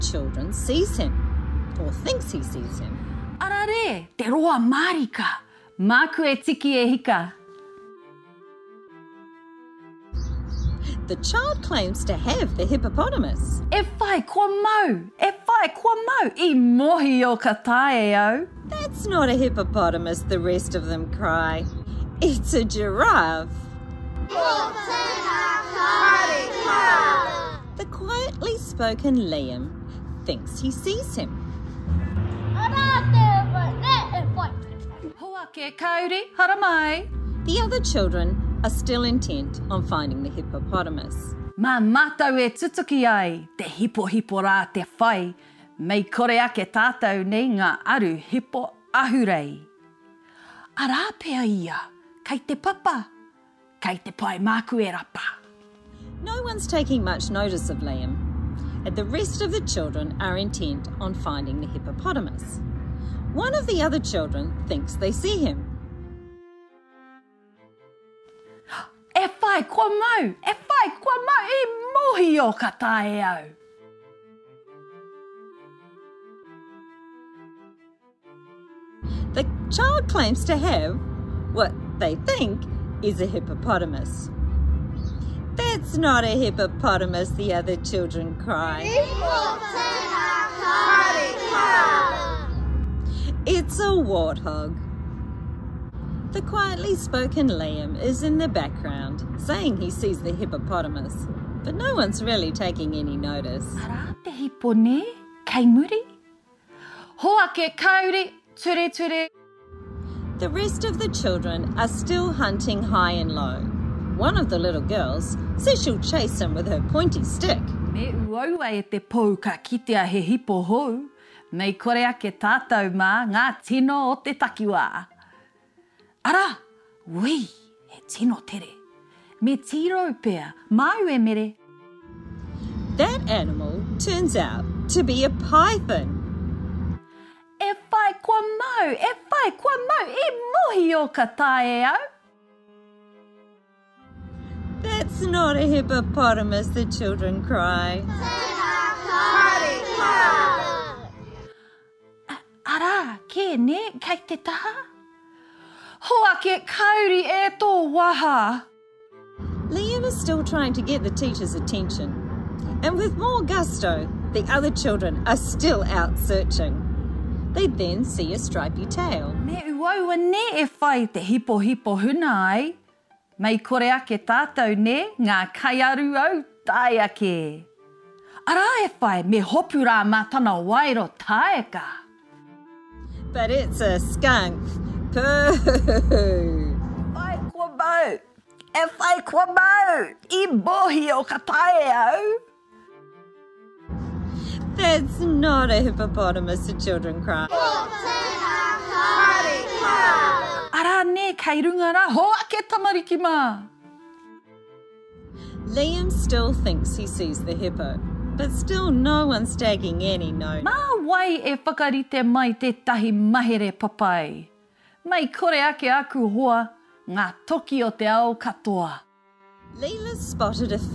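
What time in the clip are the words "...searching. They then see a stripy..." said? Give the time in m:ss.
2:46.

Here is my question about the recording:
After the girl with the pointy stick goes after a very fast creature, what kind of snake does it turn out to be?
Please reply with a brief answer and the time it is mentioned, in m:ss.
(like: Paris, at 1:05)
python, at 2:15.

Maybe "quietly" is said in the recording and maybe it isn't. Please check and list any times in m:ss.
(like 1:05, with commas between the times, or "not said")
0:27, 1:36.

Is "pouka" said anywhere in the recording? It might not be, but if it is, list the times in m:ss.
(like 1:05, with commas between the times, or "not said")
1:58.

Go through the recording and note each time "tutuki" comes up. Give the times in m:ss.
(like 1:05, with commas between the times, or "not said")
0:42.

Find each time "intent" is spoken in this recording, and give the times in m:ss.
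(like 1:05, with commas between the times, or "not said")
0:39, 1:00.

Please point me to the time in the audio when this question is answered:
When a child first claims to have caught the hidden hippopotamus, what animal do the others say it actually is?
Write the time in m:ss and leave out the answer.
0:22.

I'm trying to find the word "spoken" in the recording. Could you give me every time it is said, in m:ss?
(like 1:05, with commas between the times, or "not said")
0:28, 1:36.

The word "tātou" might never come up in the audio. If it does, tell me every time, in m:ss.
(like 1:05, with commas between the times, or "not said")
0:46, 2:02, 2:54.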